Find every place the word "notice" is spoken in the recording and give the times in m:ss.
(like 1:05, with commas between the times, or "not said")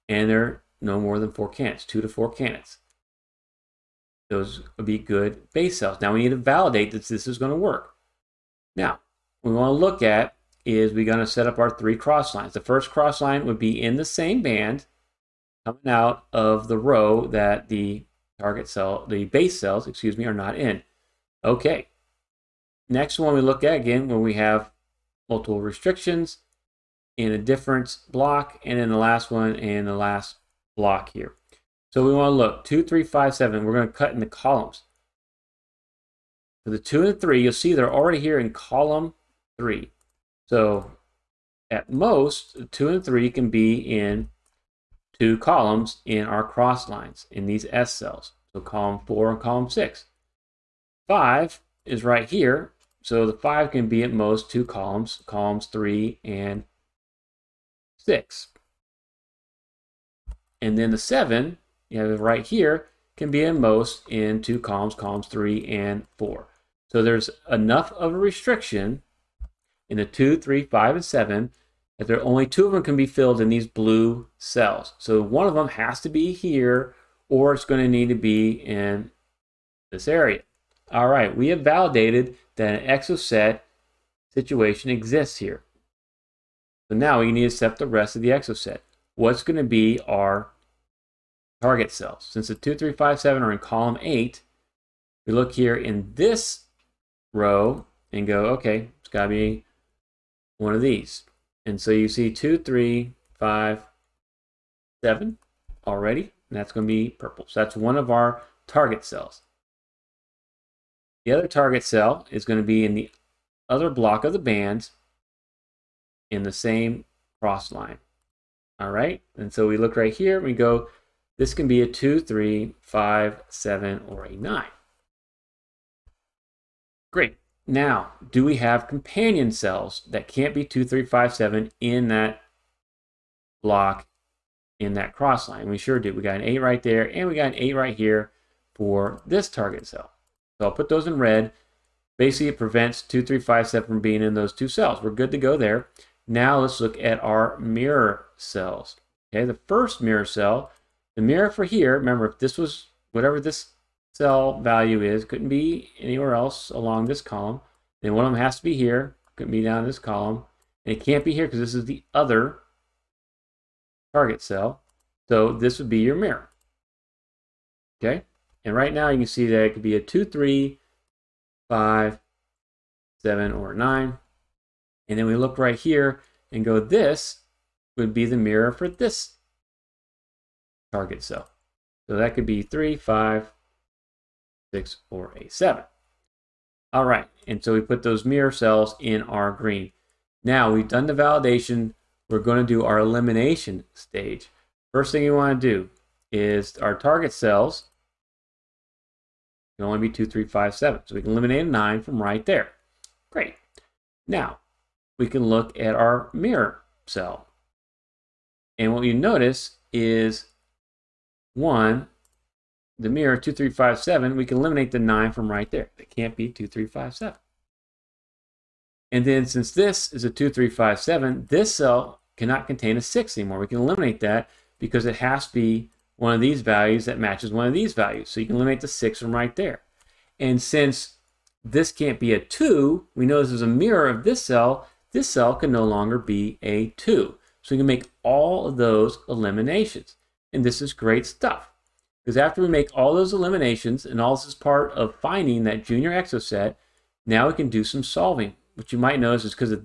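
3:29, 4:09.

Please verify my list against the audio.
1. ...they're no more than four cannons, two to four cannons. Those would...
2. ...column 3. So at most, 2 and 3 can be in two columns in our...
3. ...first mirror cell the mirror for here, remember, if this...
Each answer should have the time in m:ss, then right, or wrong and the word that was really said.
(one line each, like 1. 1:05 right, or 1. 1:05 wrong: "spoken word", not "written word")
1. 0:00 right
2. 0:38 right
3. 2:29 right.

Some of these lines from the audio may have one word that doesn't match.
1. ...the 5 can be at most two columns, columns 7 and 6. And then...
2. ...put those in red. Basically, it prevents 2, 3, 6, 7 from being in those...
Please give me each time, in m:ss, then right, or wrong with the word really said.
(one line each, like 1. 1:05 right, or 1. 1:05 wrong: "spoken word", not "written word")
1. 0:53 wrong: "3", not "7"
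2. 2:20 wrong: "5", not "6".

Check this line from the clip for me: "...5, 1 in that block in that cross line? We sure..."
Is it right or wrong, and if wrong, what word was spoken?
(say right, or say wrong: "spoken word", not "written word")
wrong: "7", not "1".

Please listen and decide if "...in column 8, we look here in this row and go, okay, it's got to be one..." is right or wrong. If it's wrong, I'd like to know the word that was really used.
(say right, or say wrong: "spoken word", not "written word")
right.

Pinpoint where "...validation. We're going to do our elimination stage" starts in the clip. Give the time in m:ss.
3:11.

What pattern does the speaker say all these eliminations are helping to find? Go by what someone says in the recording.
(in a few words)
junior exocet.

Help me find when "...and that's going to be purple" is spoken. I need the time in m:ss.
1:46.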